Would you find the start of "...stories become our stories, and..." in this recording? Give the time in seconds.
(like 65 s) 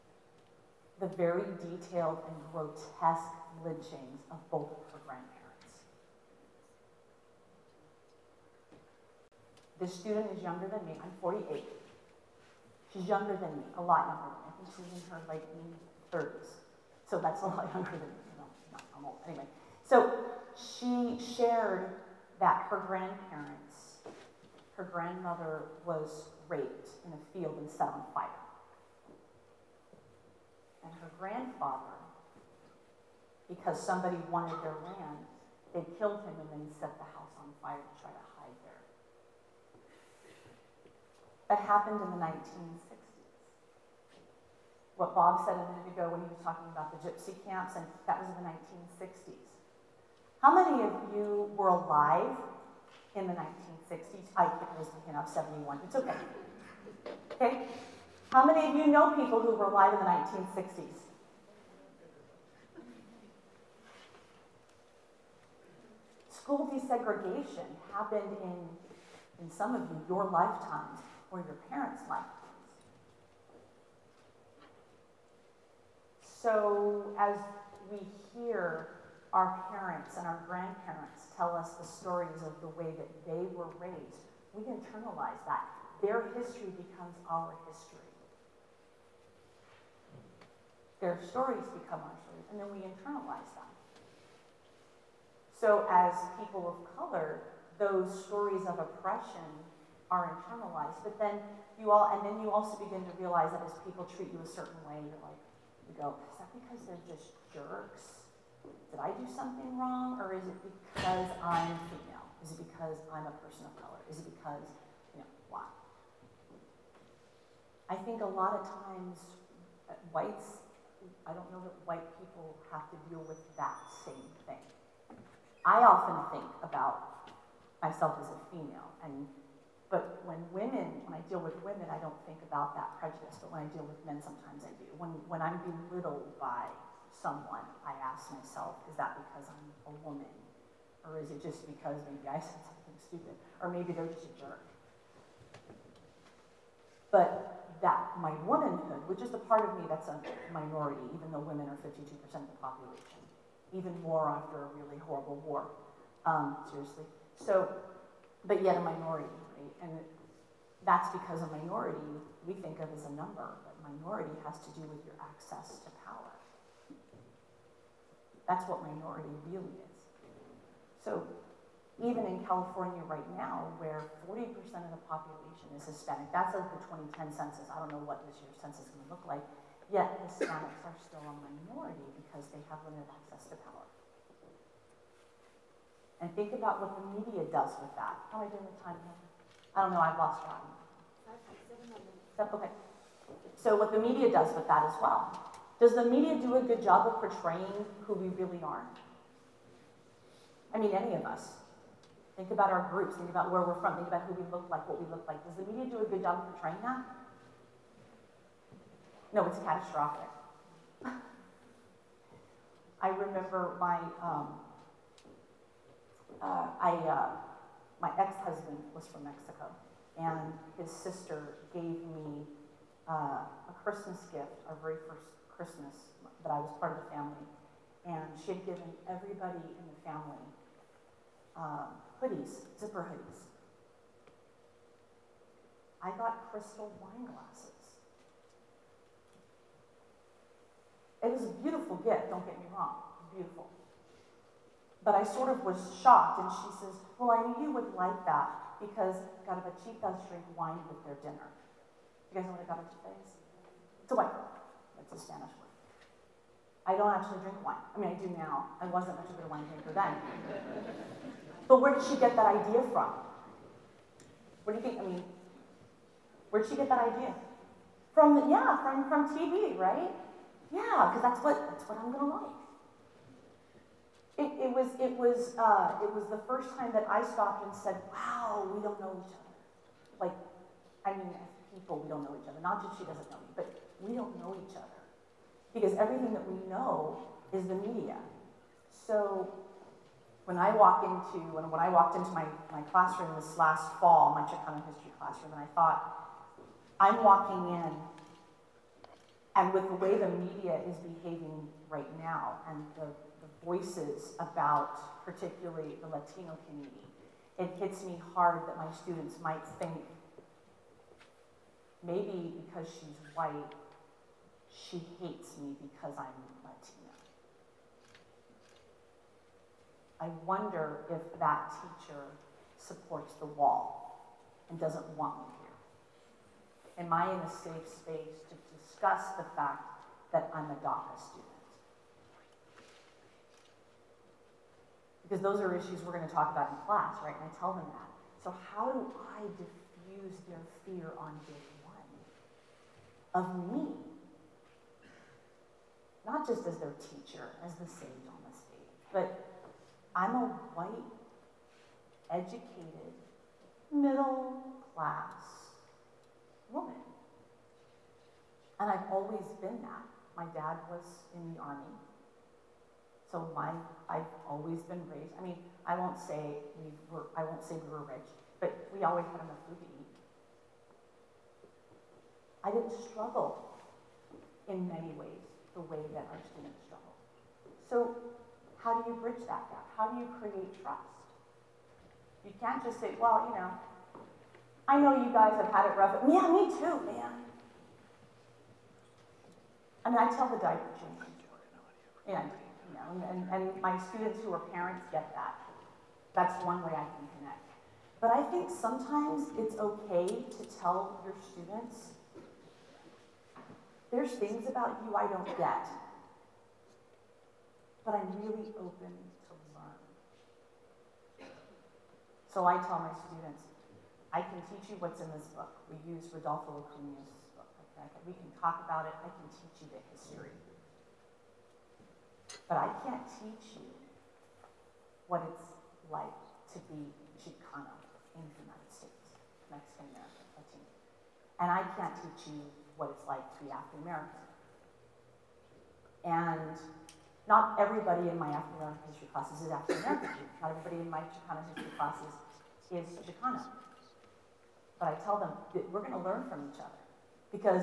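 91 s.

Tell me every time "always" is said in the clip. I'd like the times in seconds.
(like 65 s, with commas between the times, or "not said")
359 s, 364 s, 369 s.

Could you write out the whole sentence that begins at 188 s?
How am I doing with time here?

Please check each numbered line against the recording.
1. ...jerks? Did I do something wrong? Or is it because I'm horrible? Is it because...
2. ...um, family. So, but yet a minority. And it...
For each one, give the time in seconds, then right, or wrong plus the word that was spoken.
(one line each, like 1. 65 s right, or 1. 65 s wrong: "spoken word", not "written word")
1. 107 s wrong: "female", not "horrible"
2. 156 s wrong: "seriously", not "family".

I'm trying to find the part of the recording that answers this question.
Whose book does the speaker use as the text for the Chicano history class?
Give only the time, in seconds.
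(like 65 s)
416 s.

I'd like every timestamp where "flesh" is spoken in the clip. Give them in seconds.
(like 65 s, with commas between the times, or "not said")
not said.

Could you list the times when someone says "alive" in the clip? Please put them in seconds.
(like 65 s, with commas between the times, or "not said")
51 s, 59 s.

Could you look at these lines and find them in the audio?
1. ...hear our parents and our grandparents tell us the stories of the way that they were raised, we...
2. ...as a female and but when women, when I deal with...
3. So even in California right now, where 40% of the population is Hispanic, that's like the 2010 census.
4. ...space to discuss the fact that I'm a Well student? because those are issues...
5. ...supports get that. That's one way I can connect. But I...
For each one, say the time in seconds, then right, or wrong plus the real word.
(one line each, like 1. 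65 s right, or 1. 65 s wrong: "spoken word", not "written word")
1. 78 s right
2. 128 s right
3. 171 s right
4. 327 s wrong: "DACA", not "Well"
5. 394 s wrong: "parents", not "supports".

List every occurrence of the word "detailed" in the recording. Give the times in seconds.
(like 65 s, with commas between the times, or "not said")
1 s.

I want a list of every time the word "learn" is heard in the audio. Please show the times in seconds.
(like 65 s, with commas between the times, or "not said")
409 s, 446 s.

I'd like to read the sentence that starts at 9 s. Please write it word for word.
This student is younger than me, I'm 48.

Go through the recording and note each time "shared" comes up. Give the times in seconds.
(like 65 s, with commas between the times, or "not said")
21 s.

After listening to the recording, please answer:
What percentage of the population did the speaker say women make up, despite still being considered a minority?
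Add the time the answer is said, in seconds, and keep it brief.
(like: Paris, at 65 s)
52%, at 151 s.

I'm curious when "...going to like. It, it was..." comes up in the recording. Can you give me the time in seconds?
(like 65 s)
272 s.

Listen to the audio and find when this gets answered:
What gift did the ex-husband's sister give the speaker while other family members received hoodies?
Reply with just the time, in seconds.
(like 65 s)
236 s.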